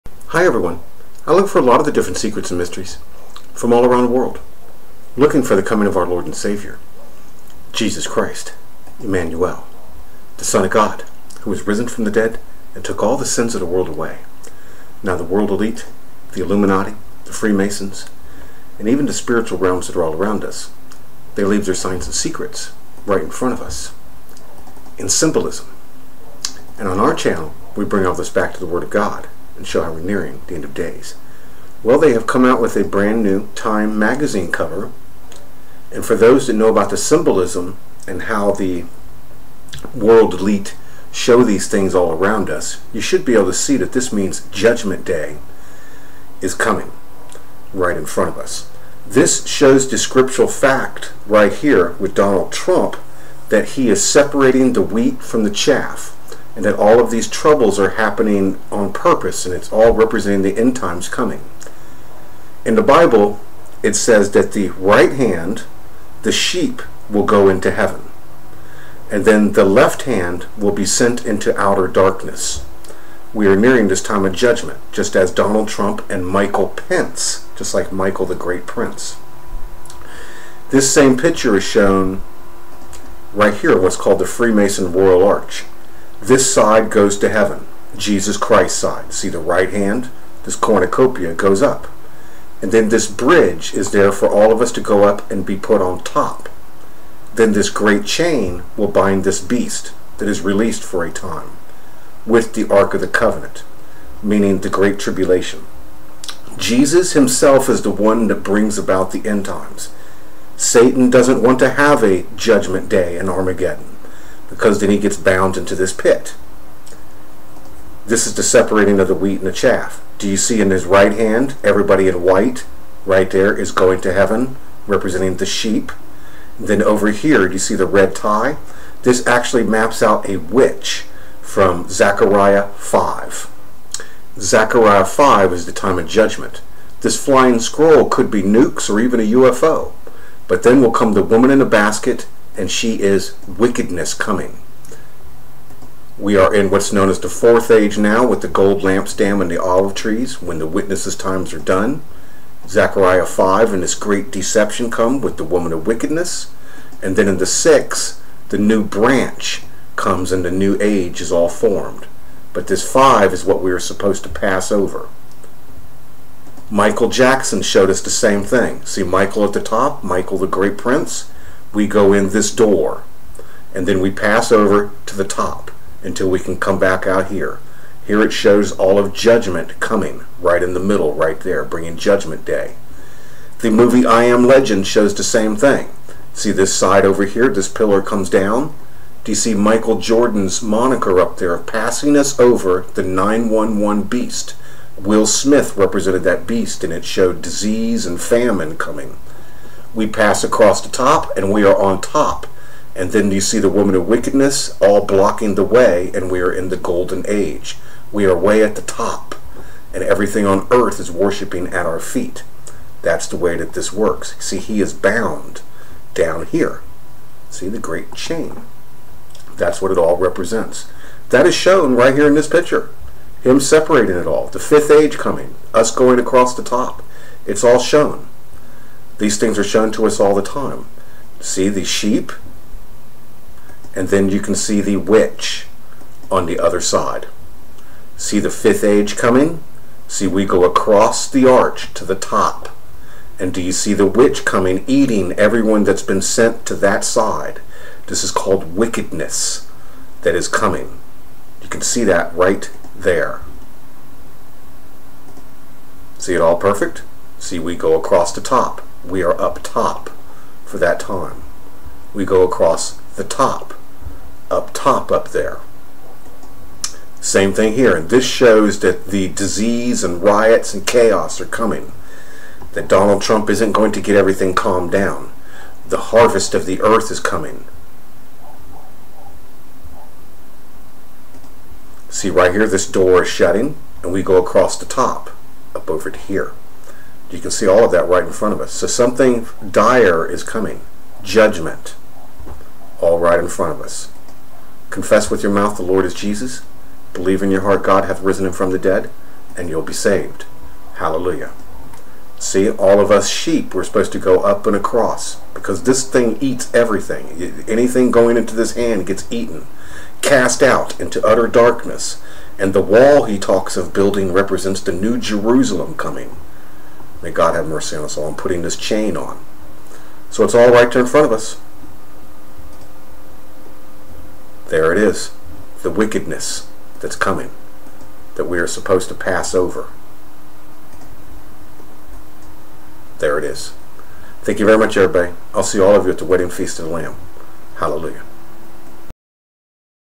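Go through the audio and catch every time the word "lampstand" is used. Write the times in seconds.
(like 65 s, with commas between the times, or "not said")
148 s.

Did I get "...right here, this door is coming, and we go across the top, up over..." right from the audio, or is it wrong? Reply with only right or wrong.
wrong.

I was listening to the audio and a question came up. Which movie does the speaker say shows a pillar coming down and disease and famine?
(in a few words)
I Am Legend.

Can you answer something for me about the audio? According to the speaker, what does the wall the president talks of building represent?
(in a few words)
the new Jerusalem.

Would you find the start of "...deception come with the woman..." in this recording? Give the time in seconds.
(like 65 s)
154 s.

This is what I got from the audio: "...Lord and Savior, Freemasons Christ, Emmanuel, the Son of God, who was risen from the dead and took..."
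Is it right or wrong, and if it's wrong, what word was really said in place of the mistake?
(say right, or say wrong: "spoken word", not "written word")
wrong: "Jesus", not "Freemasons".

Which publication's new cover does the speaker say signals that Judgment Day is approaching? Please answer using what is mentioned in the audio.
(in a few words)
Time magazine.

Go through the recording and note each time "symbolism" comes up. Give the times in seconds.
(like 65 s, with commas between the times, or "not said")
25 s, 36 s.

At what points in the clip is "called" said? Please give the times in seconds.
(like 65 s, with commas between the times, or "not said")
83 s, 248 s.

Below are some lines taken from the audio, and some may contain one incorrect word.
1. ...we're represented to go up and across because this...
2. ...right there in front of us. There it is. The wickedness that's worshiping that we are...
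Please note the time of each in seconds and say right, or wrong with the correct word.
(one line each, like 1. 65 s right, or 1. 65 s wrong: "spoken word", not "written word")
1. 303 s wrong: "supposed", not "represented"
2. 320 s wrong: "coming", not "worshiping".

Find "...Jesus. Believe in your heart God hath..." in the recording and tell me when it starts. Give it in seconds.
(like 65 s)
296 s.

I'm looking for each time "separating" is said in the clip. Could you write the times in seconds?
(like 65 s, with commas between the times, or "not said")
54 s, 118 s, 223 s.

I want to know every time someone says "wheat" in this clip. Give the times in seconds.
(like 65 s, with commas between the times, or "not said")
54 s, 119 s.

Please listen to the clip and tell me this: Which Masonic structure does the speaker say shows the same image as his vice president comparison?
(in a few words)
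Freemason Royal Arch.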